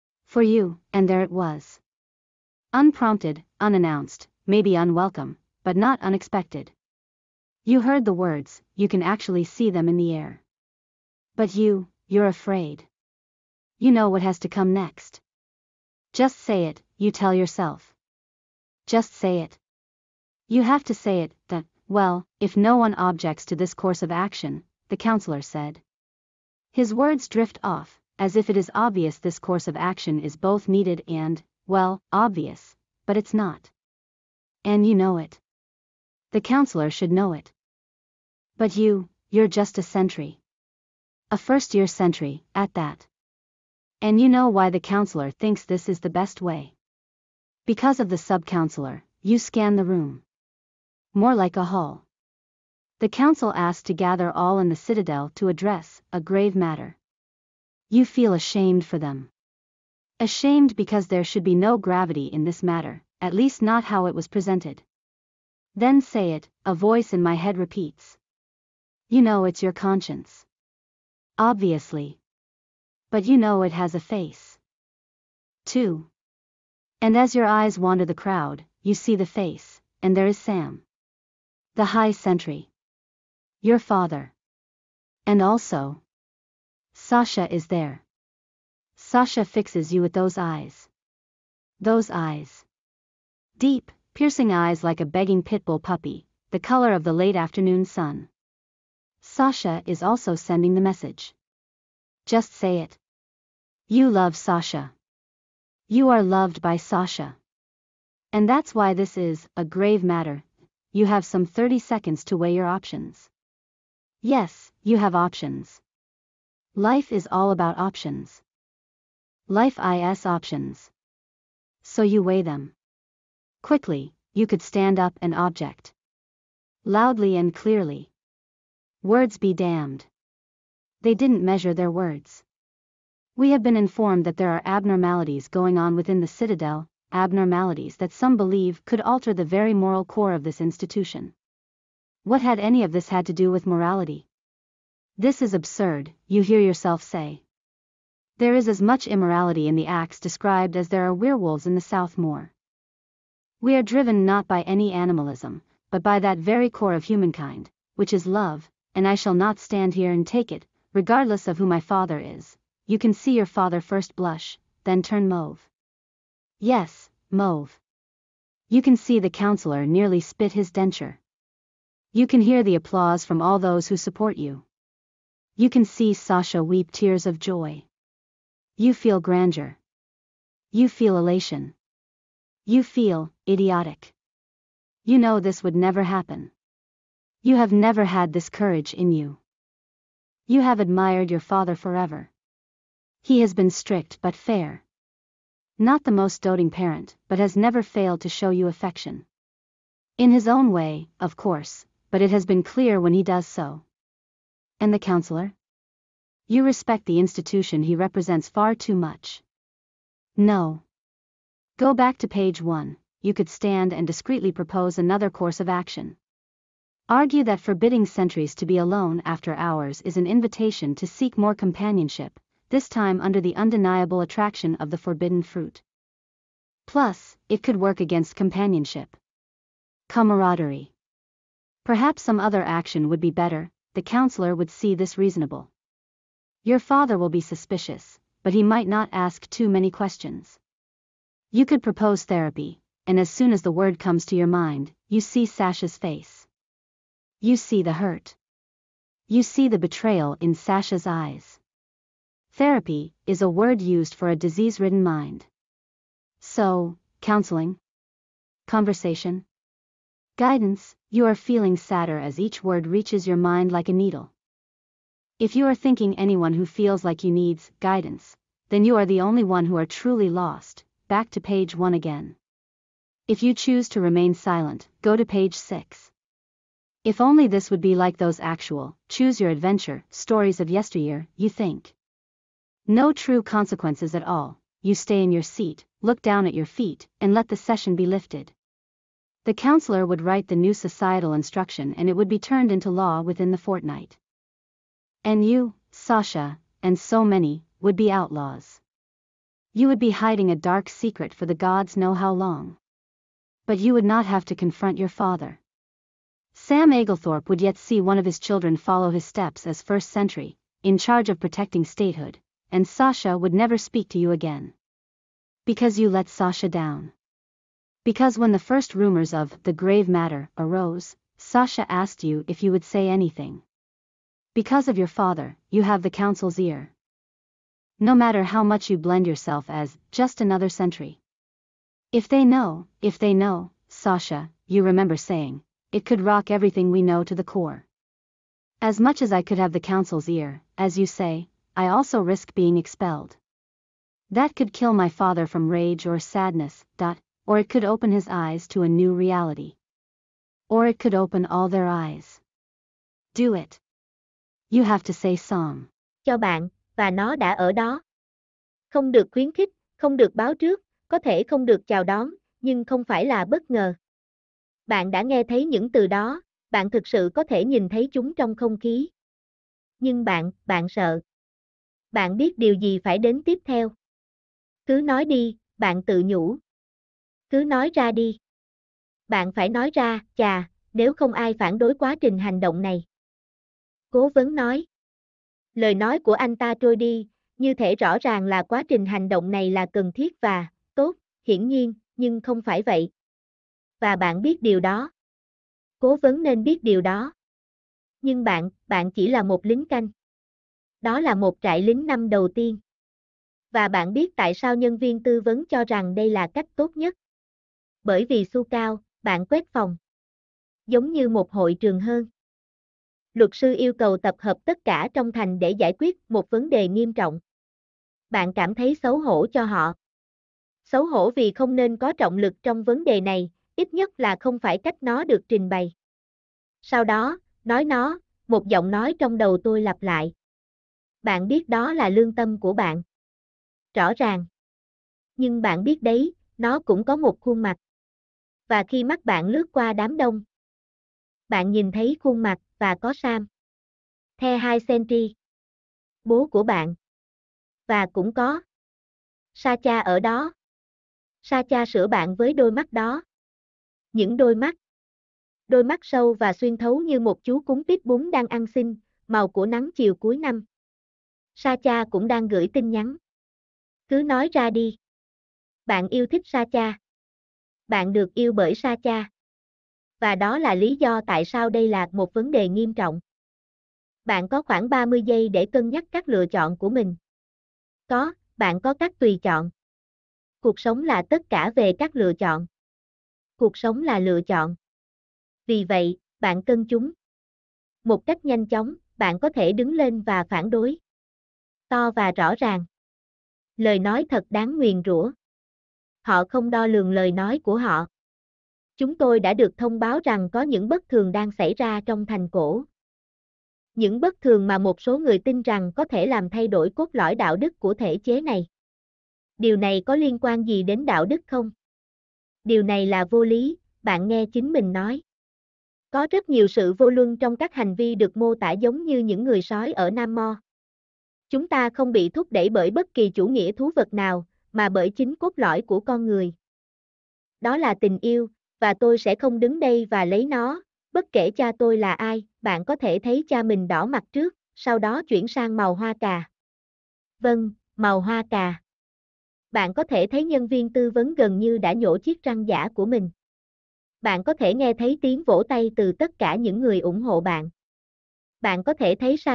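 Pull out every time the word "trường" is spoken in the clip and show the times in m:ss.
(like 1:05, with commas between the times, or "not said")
6:51.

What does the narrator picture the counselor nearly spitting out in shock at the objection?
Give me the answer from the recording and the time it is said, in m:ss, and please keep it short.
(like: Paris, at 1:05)
His denture, at 2:50.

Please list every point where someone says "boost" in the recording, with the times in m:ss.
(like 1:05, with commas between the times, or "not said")
not said.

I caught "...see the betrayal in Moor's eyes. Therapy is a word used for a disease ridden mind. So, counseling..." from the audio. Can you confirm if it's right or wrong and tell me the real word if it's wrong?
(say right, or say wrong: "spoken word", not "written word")
wrong: "Sasha", not "Moor".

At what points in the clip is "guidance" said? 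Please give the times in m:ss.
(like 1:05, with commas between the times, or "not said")
4:20, 4:27.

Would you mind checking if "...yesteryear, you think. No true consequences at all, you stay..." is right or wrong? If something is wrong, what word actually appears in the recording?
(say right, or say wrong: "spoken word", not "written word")
right.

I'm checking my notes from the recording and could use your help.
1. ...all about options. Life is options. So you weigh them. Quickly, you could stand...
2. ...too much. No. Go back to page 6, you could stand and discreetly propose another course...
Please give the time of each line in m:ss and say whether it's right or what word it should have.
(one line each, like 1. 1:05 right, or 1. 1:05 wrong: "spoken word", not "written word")
1. 1:57 right
2. 3:28 wrong: "1", not "6".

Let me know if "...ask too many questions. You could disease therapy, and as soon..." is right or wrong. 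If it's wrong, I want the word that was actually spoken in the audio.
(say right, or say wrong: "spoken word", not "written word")
wrong: "propose", not "disease".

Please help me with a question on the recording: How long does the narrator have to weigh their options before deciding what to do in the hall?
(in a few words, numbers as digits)
30 seconds.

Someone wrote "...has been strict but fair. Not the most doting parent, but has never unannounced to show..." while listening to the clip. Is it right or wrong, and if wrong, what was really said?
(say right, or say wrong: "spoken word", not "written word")
wrong: "failed", not "unannounced".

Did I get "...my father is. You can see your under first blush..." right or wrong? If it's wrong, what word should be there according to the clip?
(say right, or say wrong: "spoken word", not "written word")
wrong: "father", not "under".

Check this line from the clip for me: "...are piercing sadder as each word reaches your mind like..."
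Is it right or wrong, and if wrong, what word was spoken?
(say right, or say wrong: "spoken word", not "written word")
wrong: "feeling", not "piercing".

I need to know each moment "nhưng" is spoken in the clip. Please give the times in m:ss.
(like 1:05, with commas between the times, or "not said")
6:02, 6:09, 6:32, 6:38, 7:15.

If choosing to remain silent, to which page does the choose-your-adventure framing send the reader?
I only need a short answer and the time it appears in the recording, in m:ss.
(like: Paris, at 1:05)
Page 6, at 4:35.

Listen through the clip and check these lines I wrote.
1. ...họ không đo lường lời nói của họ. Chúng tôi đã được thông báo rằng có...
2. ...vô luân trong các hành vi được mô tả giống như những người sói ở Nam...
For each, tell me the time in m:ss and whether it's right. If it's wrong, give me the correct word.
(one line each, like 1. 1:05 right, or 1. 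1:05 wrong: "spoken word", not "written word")
1. 8:16 right
2. 8:36 right.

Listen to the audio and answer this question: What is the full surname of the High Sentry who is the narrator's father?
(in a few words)
Aglethorpe.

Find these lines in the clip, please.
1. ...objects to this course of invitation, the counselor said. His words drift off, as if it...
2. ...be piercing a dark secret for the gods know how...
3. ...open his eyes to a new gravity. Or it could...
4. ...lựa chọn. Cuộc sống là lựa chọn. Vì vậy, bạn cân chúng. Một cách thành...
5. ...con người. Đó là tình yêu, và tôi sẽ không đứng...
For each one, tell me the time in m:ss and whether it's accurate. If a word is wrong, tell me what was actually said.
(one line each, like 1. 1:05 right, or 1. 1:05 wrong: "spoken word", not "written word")
1. 0:22 wrong: "action", not "invitation"
2. 4:59 wrong: "hiding", not "piercing"
3. 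5:47 wrong: "reality", not "gravity"
4. 8:02 wrong: "nhanh", not "thành"
5. 8:45 right.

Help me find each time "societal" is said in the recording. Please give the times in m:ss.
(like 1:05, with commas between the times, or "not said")
4:50.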